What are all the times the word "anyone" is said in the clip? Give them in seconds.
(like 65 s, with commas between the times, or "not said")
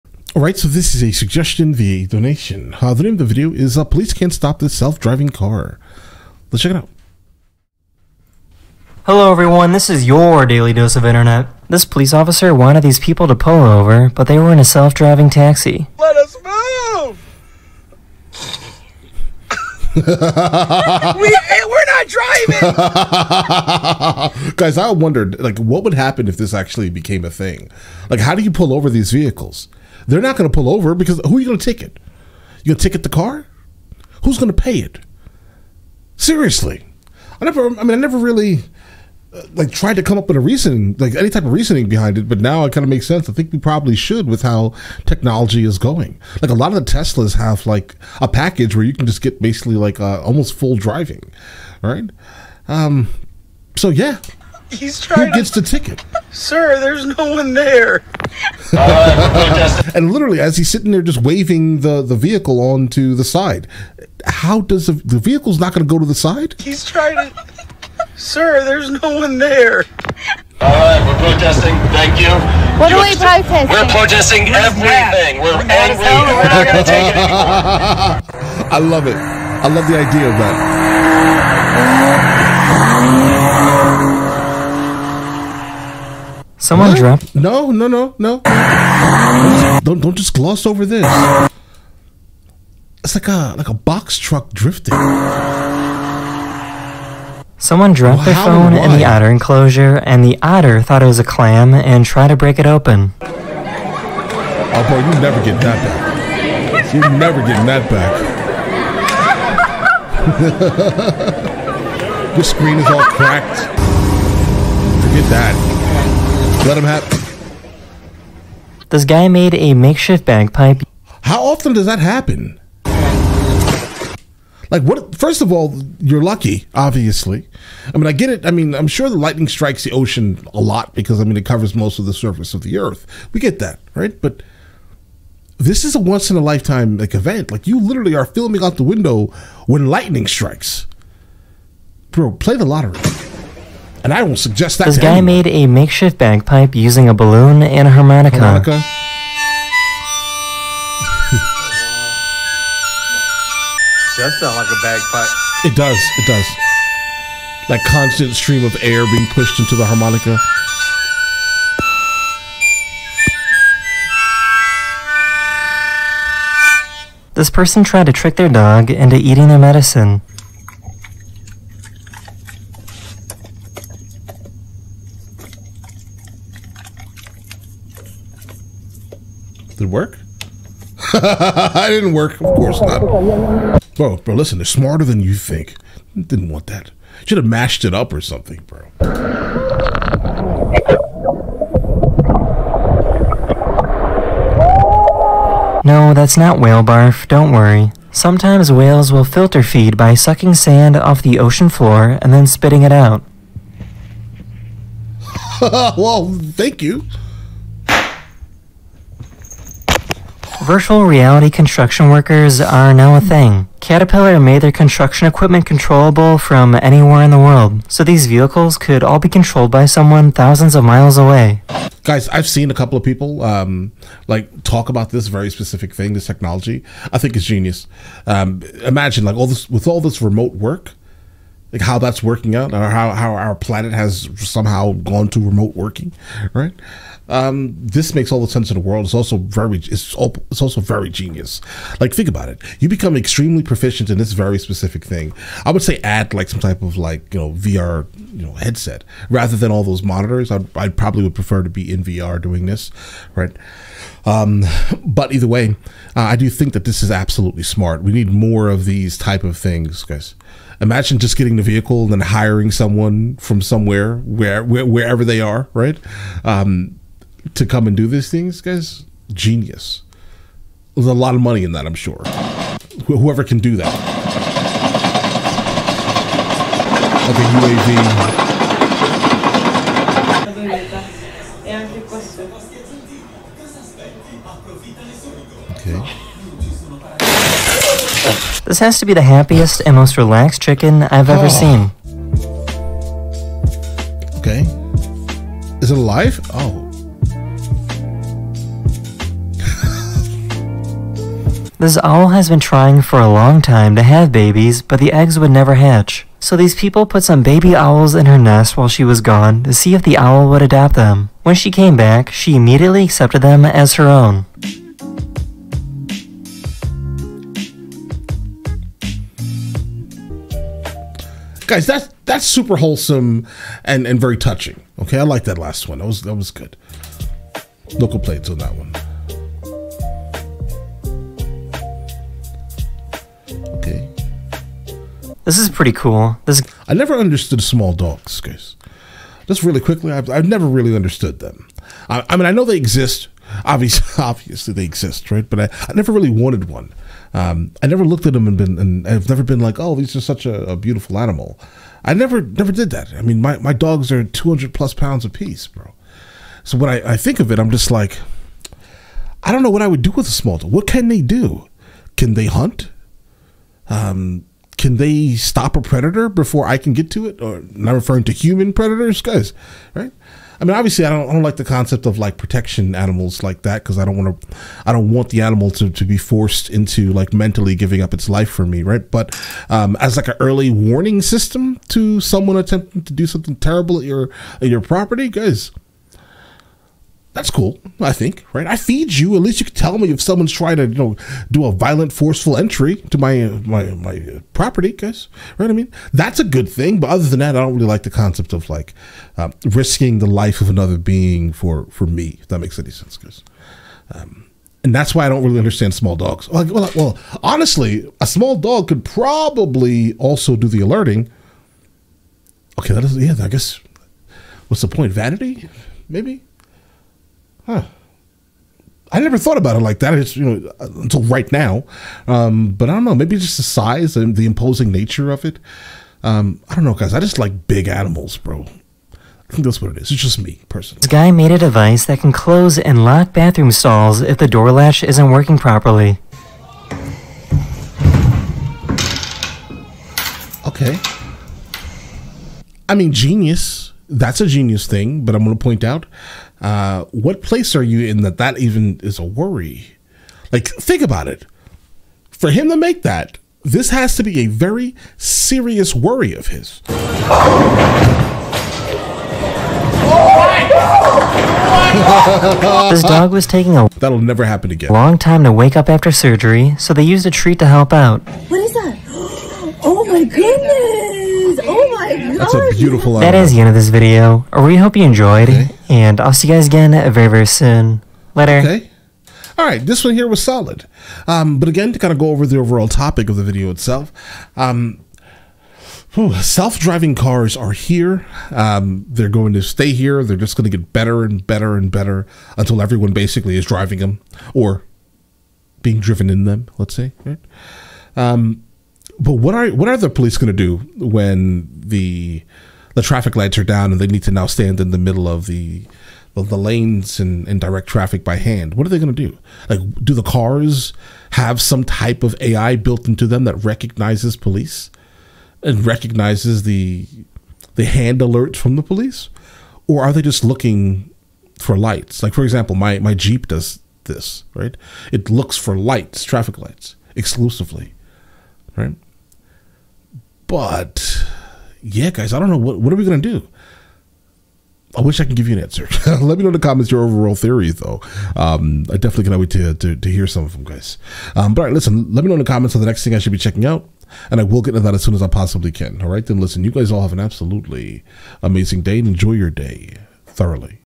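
145 s.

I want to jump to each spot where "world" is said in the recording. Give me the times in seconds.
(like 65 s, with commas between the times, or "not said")
217 s, 238 s.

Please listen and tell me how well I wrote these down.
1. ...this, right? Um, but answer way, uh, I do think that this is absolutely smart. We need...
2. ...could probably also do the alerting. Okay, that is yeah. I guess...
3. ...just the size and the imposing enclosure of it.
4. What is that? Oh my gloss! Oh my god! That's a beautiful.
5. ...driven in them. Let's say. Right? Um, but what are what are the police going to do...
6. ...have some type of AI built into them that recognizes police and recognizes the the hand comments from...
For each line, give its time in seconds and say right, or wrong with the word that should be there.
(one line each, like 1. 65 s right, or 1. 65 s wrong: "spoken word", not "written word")
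1. 252 s wrong: "either", not "answer"
2. 408 s right
3. 423 s wrong: "nature", not "enclosure"
4. 468 s wrong: "goodness", not "gloss"
5. 495 s right
6. 511 s wrong: "alerts", not "comments".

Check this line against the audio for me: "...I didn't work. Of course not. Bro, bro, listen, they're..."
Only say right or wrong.
right.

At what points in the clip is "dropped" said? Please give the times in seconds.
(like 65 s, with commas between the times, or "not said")
86 s, 97 s.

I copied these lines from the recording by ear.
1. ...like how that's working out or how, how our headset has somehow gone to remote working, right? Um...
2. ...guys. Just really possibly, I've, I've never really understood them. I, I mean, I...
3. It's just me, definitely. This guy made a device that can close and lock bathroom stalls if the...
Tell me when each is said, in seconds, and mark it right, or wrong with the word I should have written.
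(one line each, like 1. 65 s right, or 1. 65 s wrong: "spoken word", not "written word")
1. 231 s wrong: "planet", not "headset"
2. 338 s wrong: "quickly", not "possibly"
3. 430 s wrong: "personally", not "definitely".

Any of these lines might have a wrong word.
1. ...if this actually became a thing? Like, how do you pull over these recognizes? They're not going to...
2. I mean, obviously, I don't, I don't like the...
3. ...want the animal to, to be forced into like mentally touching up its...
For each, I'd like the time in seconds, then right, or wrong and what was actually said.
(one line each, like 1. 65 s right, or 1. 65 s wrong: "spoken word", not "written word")
1. 26 s wrong: "vehicles", not "recognizes"
2. 370 s right
3. 375 s wrong: "giving", not "touching".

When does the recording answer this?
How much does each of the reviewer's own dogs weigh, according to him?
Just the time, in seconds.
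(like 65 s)
354 s.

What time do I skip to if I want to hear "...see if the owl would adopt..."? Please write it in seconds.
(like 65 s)
309 s.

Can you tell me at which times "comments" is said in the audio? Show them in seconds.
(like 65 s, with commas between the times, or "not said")
536 s, 542 s.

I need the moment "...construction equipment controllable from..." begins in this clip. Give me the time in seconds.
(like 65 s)
214 s.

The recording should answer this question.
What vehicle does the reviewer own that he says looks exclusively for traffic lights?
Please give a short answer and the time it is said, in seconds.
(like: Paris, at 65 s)
Jeep, at 523 s.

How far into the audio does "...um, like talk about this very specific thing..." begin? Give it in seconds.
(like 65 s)
223 s.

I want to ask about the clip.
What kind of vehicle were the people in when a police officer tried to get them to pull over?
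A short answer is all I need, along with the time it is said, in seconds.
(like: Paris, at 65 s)
Self-driving taxi, at 14 s.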